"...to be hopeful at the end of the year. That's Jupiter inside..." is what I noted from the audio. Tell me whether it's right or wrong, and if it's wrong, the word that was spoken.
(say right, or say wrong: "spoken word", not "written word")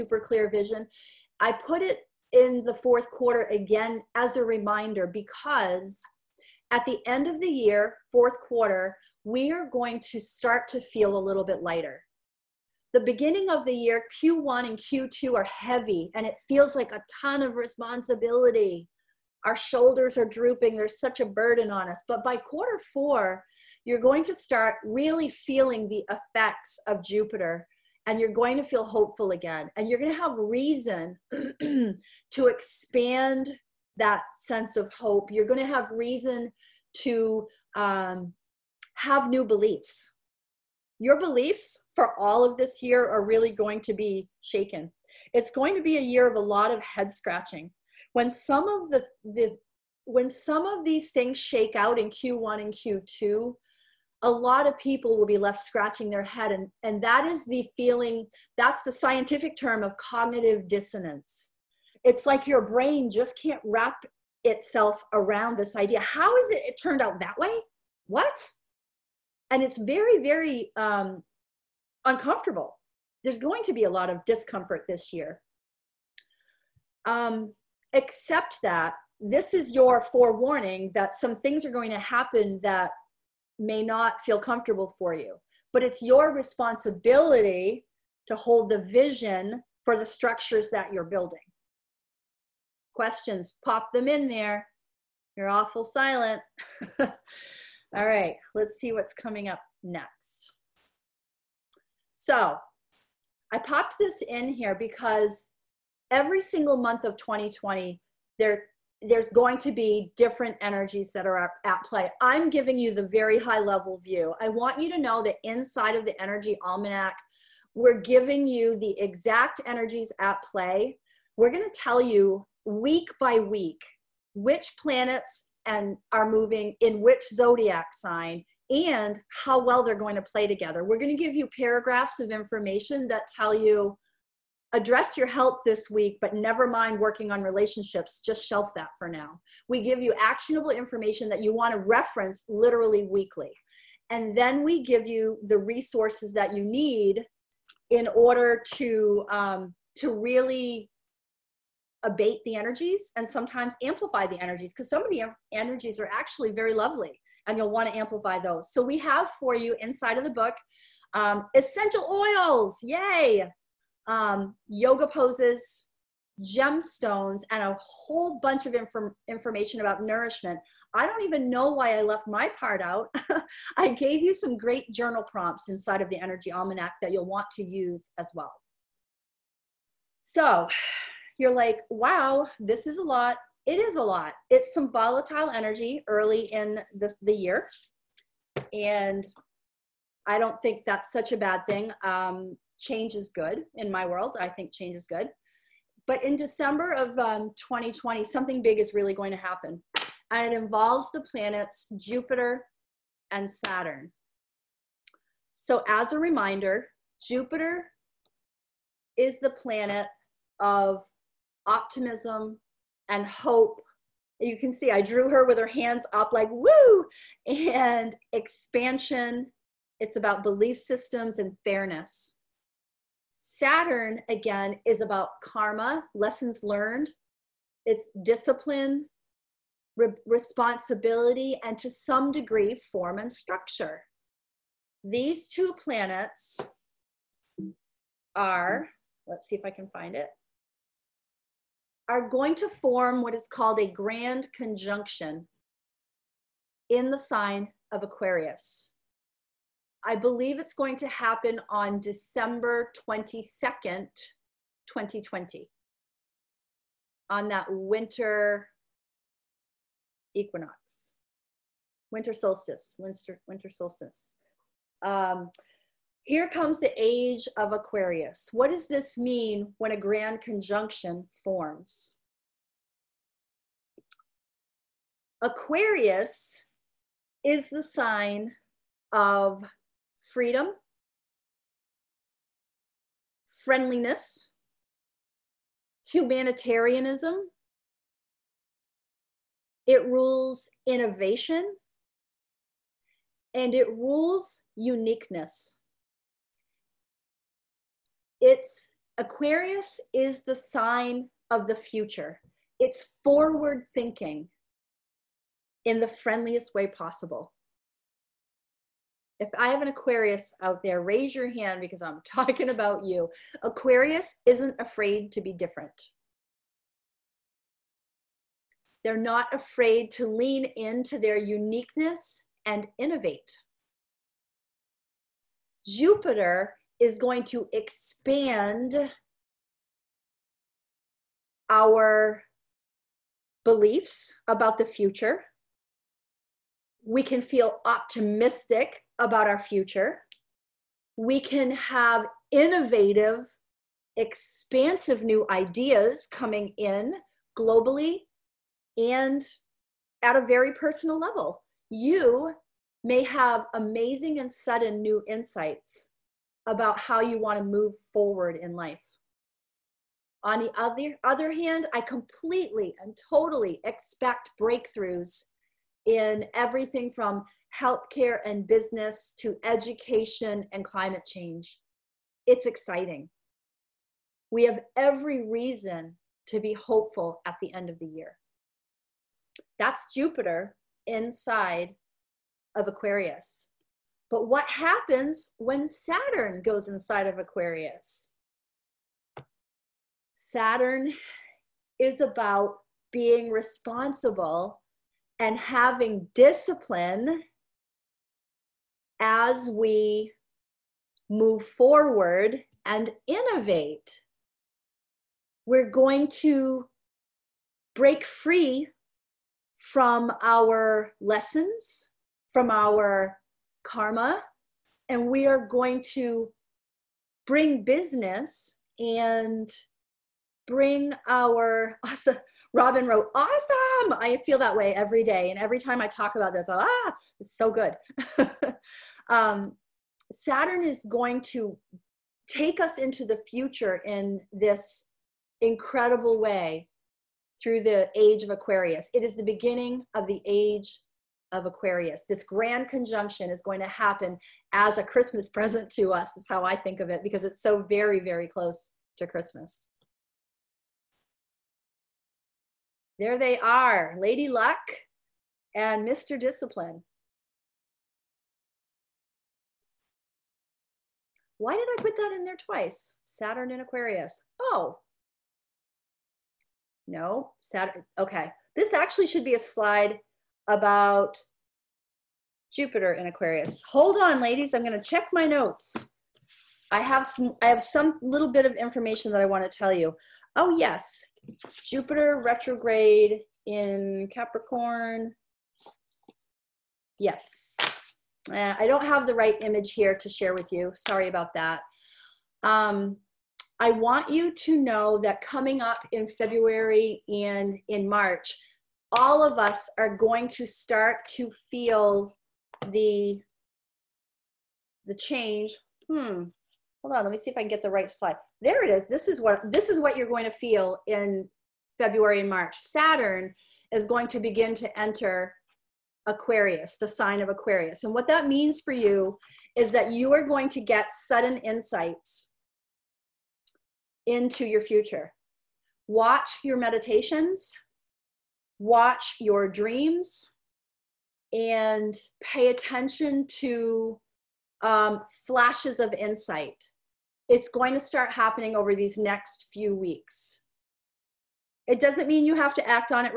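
right.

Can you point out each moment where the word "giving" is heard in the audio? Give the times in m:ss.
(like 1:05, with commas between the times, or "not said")
1:52, 1:58.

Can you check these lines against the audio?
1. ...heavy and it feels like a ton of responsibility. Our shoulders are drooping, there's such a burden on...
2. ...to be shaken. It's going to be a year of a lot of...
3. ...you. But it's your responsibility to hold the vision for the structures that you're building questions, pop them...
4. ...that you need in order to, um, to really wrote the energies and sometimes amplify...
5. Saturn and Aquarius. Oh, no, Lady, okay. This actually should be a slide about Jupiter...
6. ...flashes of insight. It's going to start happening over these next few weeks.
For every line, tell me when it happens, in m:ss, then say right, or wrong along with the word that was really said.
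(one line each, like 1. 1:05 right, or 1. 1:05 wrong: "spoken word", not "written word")
1. 0:15 right
2. 0:43 right
3. 1:25 right
4. 2:26 wrong: "abate", not "wrote"
5. 7:43 wrong: "Saturn", not "Lady"
6. 8:55 right.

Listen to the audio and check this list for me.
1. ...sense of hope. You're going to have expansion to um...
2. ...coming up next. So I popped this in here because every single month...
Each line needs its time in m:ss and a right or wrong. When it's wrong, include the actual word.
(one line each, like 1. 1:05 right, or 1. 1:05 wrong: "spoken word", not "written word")
1. 0:34 wrong: "reason", not "expansion"
2. 1:39 right.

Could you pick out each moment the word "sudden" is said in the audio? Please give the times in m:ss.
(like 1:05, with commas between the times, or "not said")
5:54, 8:41.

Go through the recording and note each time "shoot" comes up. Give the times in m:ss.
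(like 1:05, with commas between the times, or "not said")
not said.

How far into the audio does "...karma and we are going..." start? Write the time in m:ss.
6:53.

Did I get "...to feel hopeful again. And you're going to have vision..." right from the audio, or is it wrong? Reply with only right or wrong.
wrong.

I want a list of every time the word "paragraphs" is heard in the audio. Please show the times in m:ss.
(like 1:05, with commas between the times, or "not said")
2:11.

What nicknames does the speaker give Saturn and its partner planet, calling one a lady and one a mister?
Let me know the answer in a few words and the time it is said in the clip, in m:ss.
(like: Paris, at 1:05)
Lady Luck and Mr. Discipline, at 7:34.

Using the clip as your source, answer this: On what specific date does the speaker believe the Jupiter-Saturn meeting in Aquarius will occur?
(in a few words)
December 22nd, 2020.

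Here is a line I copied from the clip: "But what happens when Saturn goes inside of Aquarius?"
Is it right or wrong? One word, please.
right.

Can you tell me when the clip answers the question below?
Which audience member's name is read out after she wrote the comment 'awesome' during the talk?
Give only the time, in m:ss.
7:02.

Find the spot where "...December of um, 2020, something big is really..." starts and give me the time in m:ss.
3:16.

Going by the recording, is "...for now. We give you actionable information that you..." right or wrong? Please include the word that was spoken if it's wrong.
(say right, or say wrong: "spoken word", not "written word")
right.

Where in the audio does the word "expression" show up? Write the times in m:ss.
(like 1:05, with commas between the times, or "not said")
not said.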